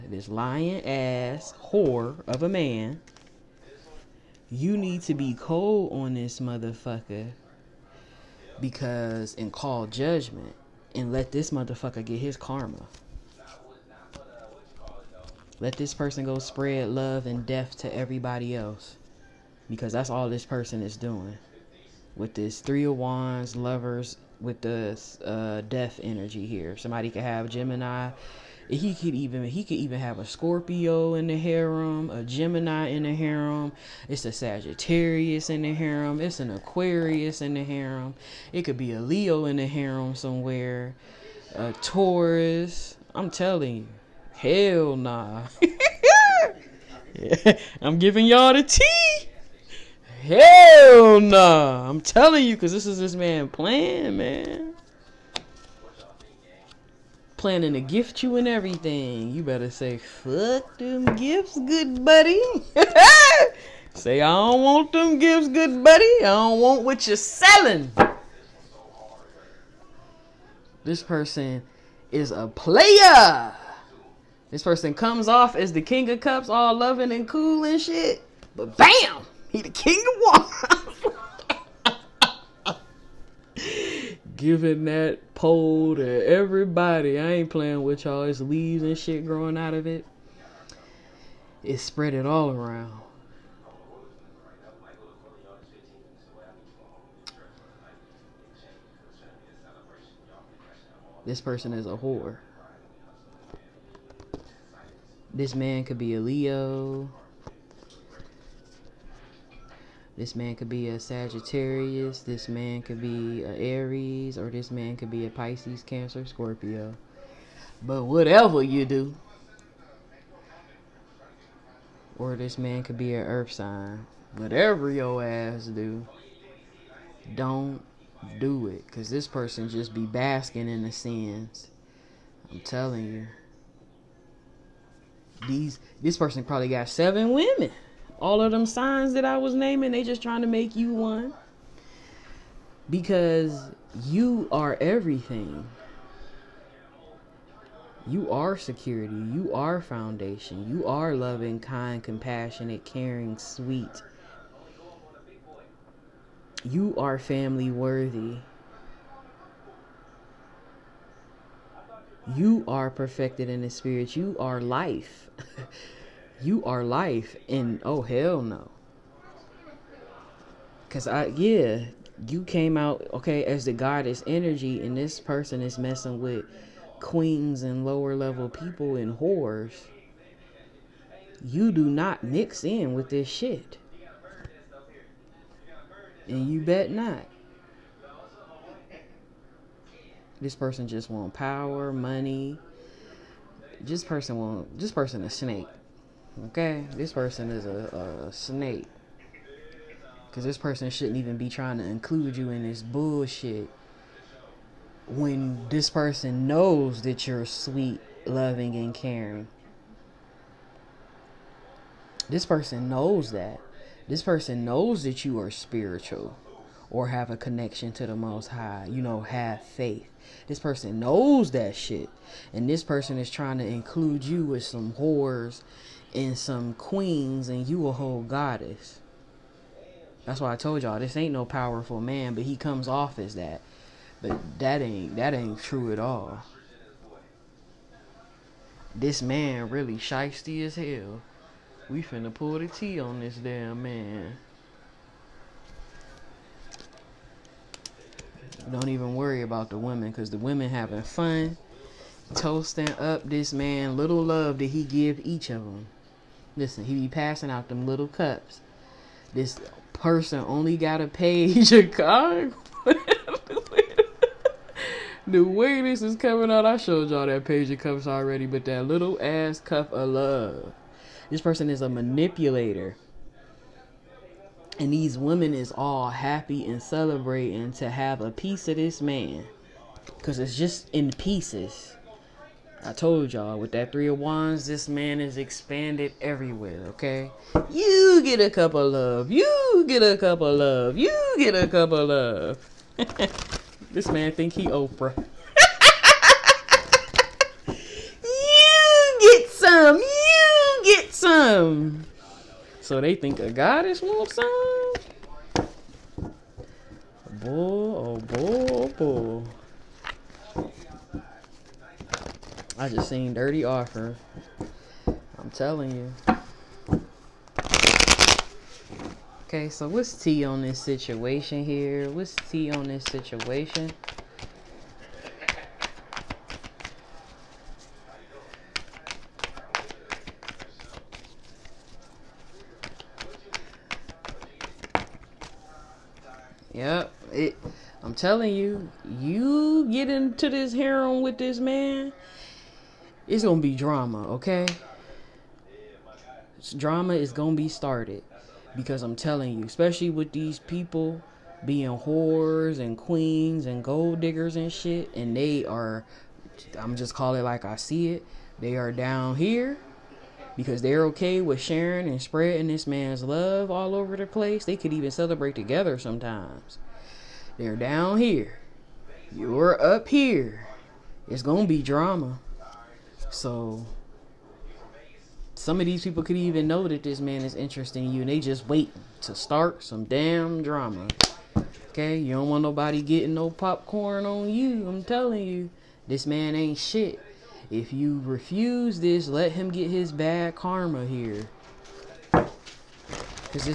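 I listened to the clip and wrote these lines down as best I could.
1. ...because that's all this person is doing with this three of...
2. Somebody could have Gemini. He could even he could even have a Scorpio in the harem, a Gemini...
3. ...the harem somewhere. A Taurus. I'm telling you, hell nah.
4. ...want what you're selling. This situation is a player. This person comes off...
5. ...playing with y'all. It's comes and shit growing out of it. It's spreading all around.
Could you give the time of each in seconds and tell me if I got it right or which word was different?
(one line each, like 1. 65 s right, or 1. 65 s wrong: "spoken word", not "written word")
1. 19 s right
2. 26 s right
3. 39 s right
4. 66 s wrong: "person", not "situation"
5. 87 s wrong: "leaves", not "comes".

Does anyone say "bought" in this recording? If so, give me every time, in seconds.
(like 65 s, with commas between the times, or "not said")
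not said.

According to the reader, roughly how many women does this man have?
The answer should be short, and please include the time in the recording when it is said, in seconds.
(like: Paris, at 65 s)
7, at 136 s.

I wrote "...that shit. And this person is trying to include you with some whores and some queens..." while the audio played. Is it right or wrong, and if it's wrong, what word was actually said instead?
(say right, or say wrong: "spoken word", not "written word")
right.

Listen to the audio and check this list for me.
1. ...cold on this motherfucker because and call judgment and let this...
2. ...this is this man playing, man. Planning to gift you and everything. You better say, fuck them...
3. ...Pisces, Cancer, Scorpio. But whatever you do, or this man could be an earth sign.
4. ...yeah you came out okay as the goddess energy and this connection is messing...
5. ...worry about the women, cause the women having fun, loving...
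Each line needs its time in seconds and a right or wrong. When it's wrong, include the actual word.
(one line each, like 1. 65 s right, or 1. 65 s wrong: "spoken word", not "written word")
1. 5 s right
2. 52 s right
3. 115 s right
4. 171 s wrong: "person", not "connection"
5. 249 s wrong: "toasting", not "loving".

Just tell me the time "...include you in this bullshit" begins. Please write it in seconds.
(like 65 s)
201 s.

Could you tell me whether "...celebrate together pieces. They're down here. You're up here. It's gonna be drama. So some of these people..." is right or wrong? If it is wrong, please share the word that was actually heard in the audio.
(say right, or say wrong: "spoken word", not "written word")
wrong: "sometimes", not "pieces".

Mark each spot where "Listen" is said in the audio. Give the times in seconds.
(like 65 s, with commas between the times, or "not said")
256 s.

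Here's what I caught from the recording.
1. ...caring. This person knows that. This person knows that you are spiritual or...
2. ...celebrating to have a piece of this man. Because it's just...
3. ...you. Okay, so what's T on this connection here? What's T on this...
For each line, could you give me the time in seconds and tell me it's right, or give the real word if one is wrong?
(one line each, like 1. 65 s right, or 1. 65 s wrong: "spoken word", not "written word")
1. 208 s right
2. 276 s right
3. 315 s wrong: "situation", not "connection".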